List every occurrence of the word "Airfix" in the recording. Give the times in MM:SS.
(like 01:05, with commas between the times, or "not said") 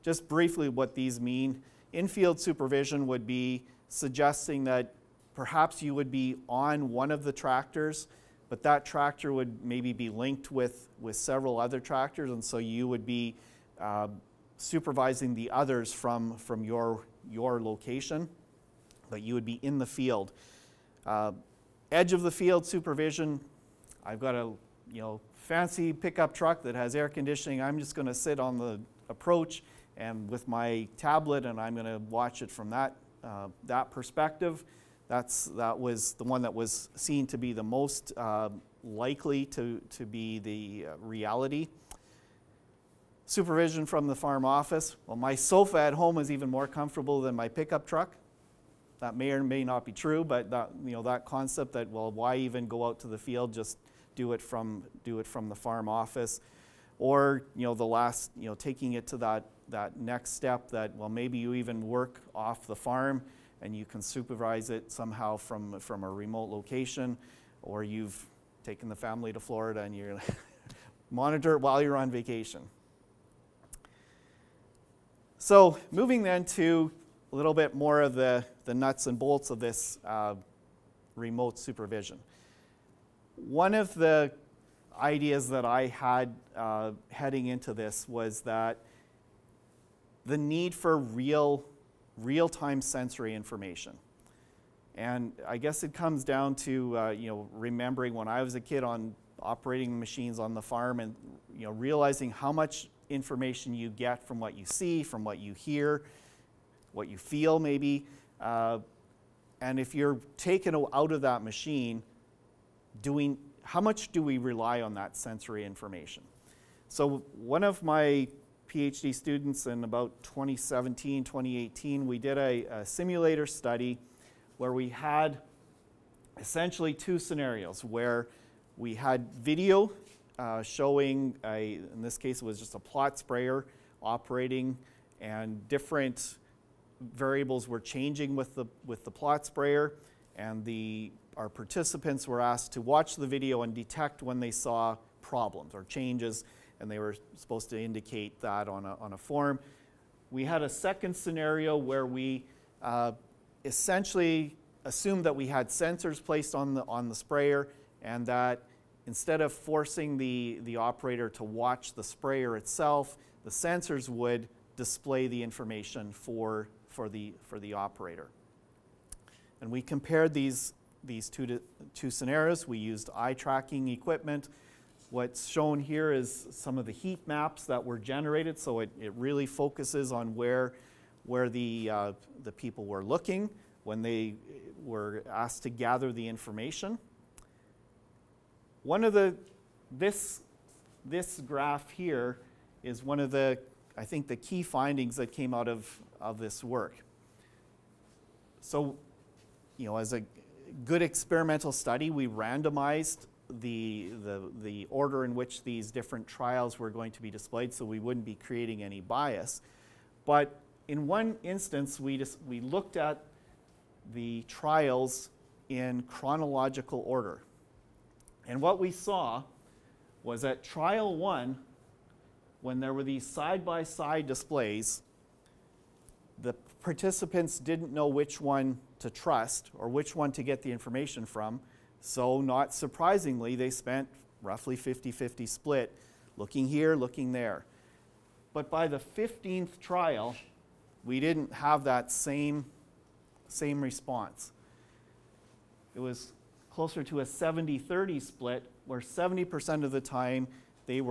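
not said.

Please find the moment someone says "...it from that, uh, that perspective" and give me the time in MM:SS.
00:32.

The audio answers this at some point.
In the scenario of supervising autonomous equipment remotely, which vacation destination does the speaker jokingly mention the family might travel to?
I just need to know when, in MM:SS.
01:09.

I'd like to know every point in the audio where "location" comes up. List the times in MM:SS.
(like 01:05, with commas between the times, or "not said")
00:17, 01:06.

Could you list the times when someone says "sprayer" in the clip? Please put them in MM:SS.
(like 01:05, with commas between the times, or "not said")
02:13, 02:19, 02:37, 02:42.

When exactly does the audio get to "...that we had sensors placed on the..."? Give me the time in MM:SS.
02:35.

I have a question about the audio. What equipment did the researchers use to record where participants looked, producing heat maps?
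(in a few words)
eye tracking equipment.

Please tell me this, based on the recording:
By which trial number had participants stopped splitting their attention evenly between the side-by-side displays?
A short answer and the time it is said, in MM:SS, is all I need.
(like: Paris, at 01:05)
15th, at 03:59.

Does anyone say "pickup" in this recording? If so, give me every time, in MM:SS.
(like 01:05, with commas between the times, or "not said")
00:25, 00:47.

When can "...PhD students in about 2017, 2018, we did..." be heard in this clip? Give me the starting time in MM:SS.
01:58.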